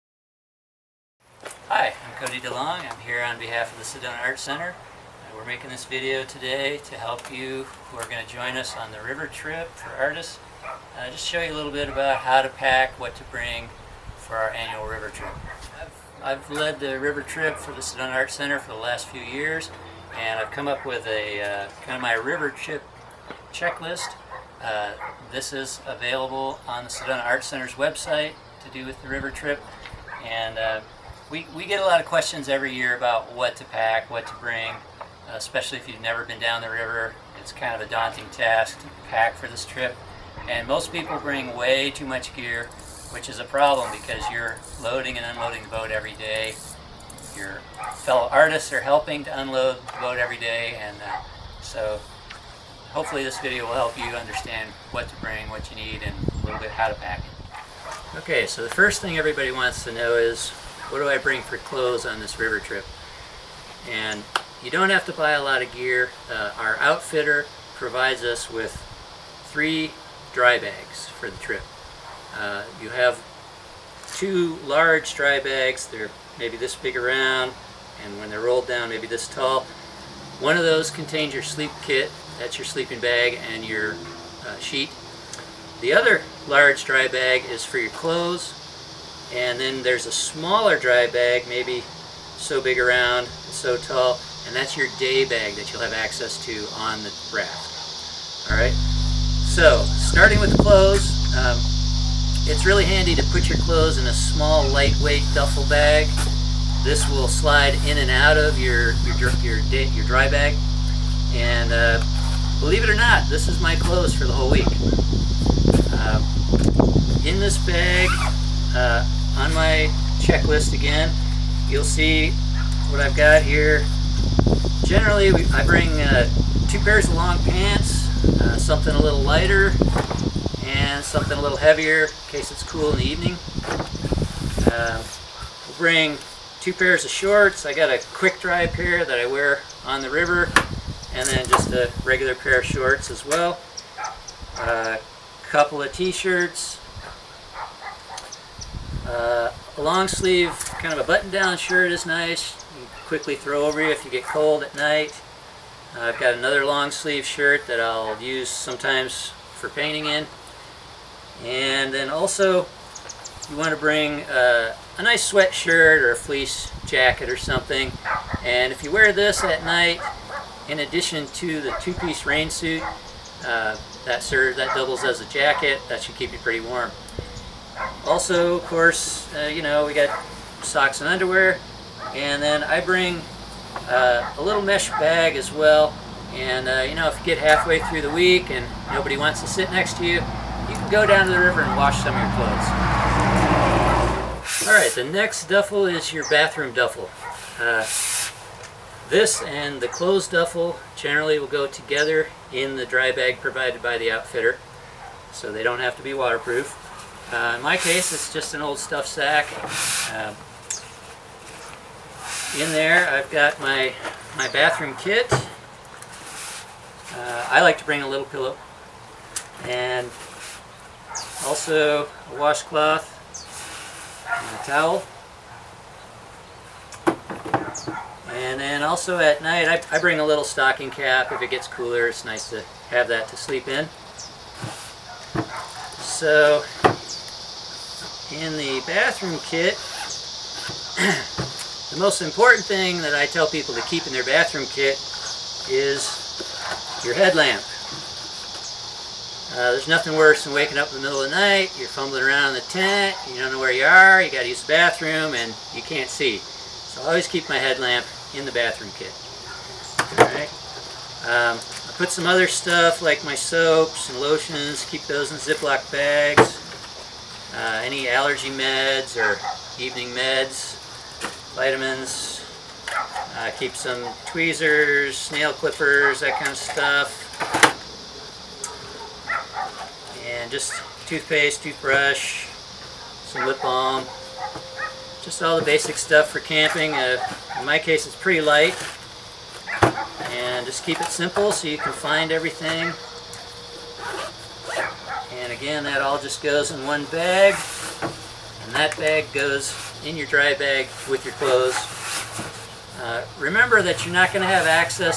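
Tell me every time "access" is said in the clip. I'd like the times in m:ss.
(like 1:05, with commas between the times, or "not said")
1:35, 5:04.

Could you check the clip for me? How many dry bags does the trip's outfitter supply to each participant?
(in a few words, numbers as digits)
3.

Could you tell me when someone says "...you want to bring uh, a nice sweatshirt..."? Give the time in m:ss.
2:43.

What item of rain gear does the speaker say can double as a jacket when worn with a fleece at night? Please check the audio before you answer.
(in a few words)
Two-piece rain suit.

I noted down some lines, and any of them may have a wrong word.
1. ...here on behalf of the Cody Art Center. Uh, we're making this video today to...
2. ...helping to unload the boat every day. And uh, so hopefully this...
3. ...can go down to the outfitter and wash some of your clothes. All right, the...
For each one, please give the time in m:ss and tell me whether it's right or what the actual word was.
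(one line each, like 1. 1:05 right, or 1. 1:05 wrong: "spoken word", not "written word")
1. 0:03 wrong: "Sedona", not "Cody"
2. 0:48 right
3. 3:10 wrong: "river", not "outfitter".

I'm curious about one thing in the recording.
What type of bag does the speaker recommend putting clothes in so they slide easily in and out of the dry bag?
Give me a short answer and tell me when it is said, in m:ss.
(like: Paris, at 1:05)
Duffel bag, at 1:44.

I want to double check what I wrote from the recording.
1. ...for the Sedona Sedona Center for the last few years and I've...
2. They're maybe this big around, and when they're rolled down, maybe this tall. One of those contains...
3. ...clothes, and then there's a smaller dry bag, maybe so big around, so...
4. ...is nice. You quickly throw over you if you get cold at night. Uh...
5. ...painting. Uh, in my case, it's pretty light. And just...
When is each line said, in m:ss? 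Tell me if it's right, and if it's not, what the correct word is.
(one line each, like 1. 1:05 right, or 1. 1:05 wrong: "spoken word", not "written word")
1. 0:17 wrong: "Art", not "Sedona"
2. 1:15 right
3. 1:27 right
4. 2:31 right
5. 4:46 wrong: "camping", not "painting".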